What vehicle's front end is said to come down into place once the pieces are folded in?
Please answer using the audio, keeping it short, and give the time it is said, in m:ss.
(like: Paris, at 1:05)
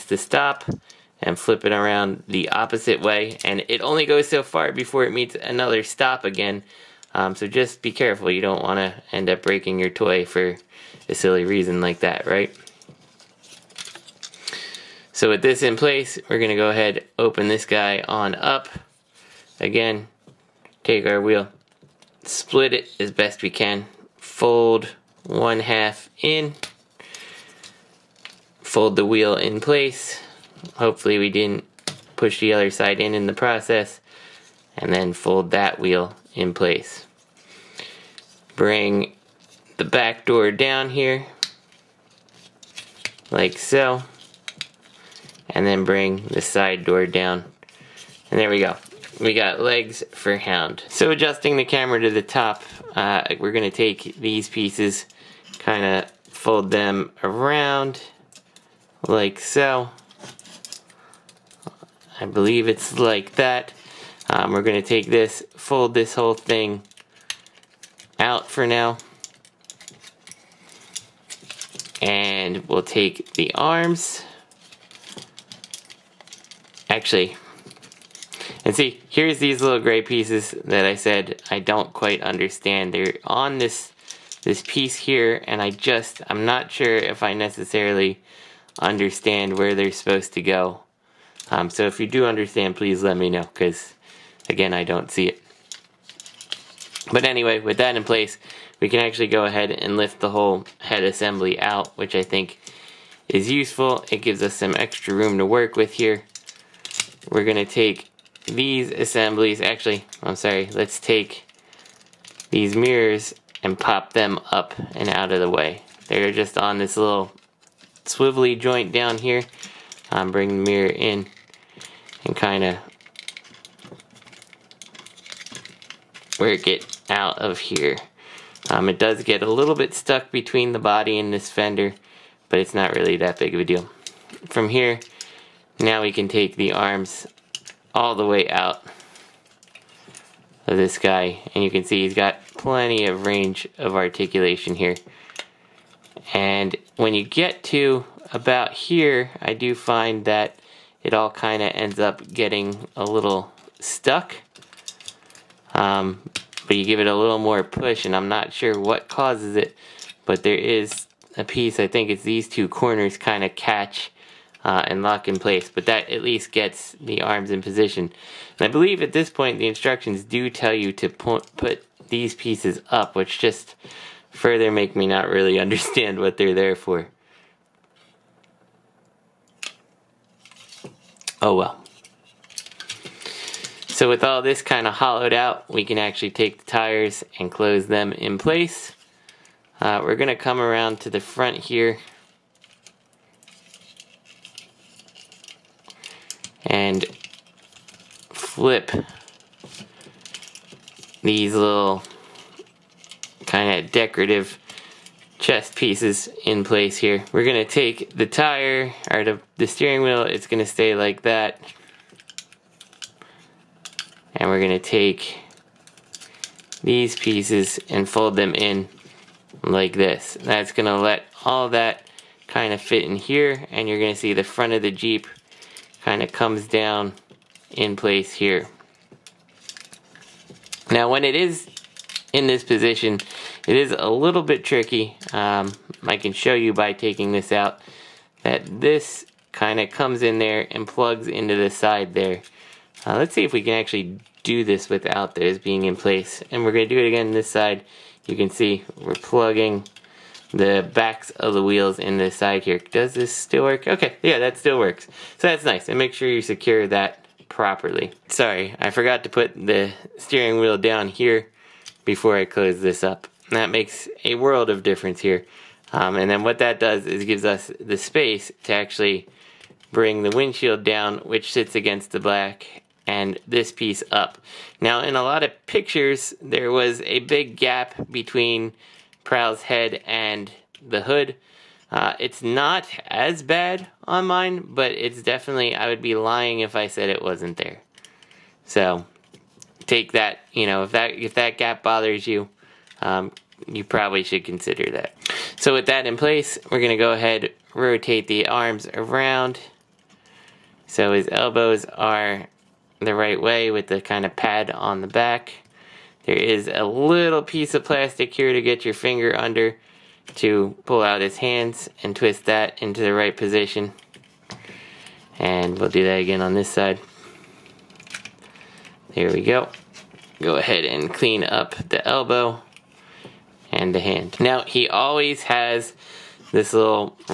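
Jeep, at 3:44.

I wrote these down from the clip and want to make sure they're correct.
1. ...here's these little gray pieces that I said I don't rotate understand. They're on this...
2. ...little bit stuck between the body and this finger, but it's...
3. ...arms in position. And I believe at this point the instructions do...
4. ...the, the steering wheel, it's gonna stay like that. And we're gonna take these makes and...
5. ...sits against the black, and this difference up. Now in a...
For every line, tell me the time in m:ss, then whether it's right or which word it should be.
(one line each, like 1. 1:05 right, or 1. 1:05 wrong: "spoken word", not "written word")
1. 1:19 wrong: "quite", not "rotate"
2. 2:09 wrong: "fender", not "finger"
3. 2:47 right
4. 3:29 wrong: "pieces", not "makes"
5. 4:31 wrong: "piece", not "difference".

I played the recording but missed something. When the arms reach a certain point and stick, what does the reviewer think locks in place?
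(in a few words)
two corners.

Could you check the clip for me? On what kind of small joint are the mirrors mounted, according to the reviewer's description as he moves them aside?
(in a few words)
swivelly joint.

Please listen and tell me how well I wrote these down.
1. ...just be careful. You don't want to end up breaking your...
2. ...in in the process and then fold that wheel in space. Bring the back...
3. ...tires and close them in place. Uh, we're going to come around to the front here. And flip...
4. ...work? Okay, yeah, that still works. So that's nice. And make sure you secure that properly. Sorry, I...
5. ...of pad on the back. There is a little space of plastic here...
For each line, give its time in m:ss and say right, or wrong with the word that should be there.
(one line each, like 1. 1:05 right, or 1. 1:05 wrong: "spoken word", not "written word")
1. 0:07 right
2. 0:32 wrong: "place", not "space"
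3. 3:06 right
4. 4:13 right
5. 5:04 wrong: "piece", not "space".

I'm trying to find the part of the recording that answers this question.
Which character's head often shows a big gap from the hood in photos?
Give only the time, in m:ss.
4:39.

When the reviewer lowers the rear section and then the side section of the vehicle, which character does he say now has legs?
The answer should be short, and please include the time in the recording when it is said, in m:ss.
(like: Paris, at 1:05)
Hound, at 0:50.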